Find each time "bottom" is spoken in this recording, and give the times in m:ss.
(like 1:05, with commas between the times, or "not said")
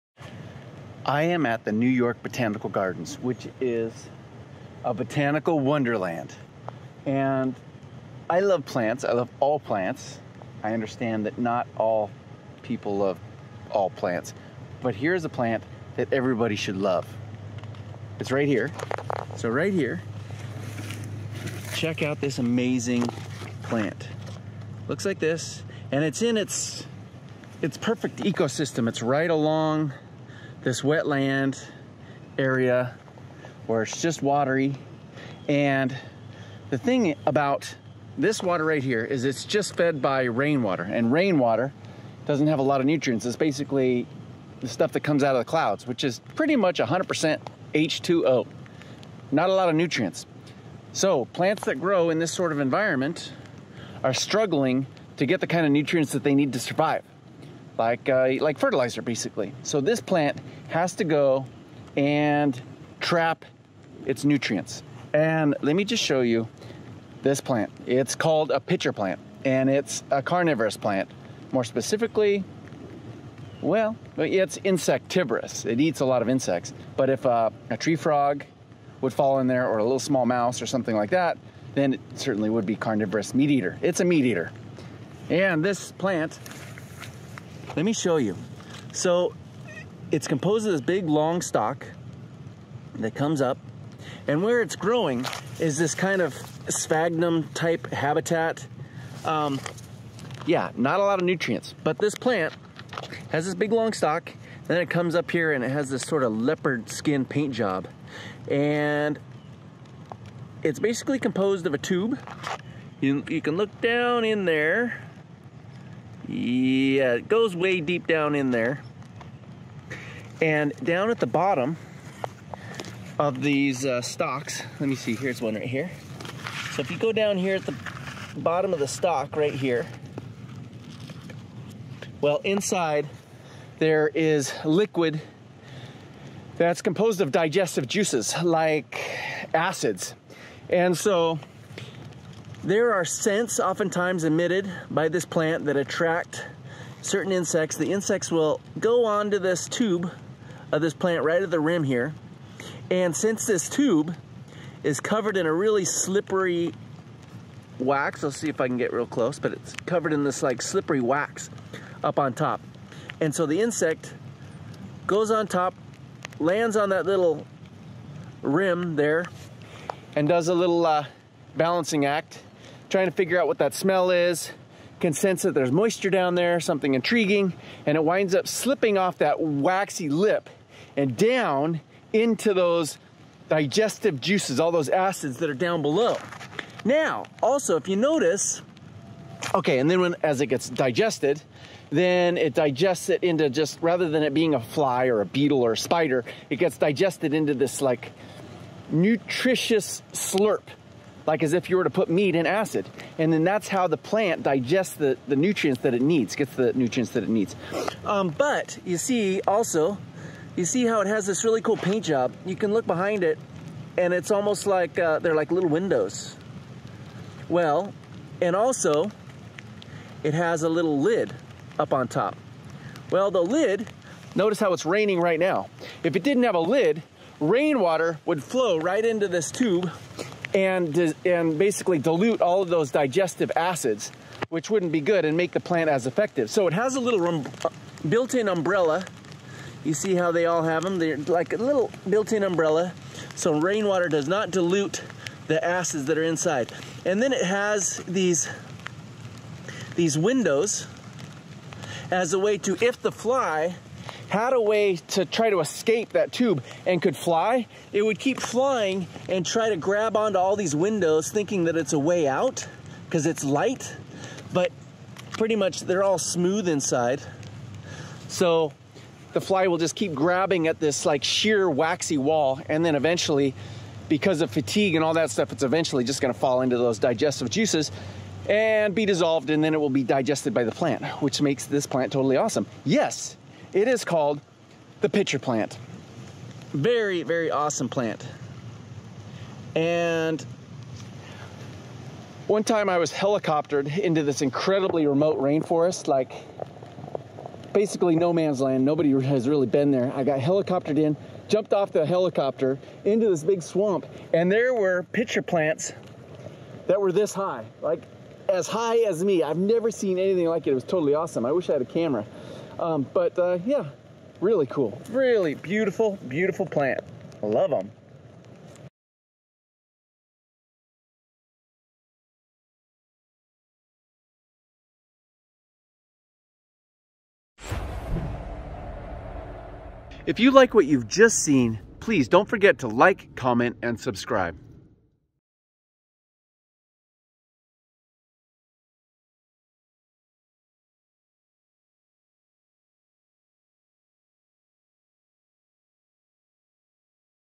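2:01, 2:08.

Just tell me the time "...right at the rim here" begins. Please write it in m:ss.
2:31.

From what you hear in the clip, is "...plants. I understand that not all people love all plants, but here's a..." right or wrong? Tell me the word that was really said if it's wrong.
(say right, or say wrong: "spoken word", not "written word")
right.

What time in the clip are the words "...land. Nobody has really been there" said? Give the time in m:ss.
4:58.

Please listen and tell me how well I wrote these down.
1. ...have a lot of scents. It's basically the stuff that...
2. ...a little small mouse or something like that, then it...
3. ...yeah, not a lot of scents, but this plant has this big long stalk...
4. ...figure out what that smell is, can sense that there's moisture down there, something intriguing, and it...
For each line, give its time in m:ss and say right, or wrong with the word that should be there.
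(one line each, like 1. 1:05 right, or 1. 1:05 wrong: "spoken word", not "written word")
1. 0:42 wrong: "nutrients", not "scents"
2. 1:19 right
3. 1:40 wrong: "nutrients", not "scents"
4. 2:53 right.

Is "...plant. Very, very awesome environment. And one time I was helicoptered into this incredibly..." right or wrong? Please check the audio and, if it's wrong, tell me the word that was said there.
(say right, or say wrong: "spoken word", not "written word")
wrong: "plant", not "environment".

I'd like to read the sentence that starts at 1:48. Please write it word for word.
And it's basically composed of a tube.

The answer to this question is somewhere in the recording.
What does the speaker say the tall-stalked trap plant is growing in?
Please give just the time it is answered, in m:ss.
1:36.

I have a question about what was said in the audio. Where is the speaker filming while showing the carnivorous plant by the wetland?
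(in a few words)
New York Botanical Gardens.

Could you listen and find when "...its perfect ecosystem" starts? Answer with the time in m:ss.
0:27.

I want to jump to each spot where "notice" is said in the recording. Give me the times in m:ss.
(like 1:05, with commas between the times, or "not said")
3:07, 3:44.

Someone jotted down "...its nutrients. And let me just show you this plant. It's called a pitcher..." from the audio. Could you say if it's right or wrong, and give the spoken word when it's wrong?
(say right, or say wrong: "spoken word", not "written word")
right.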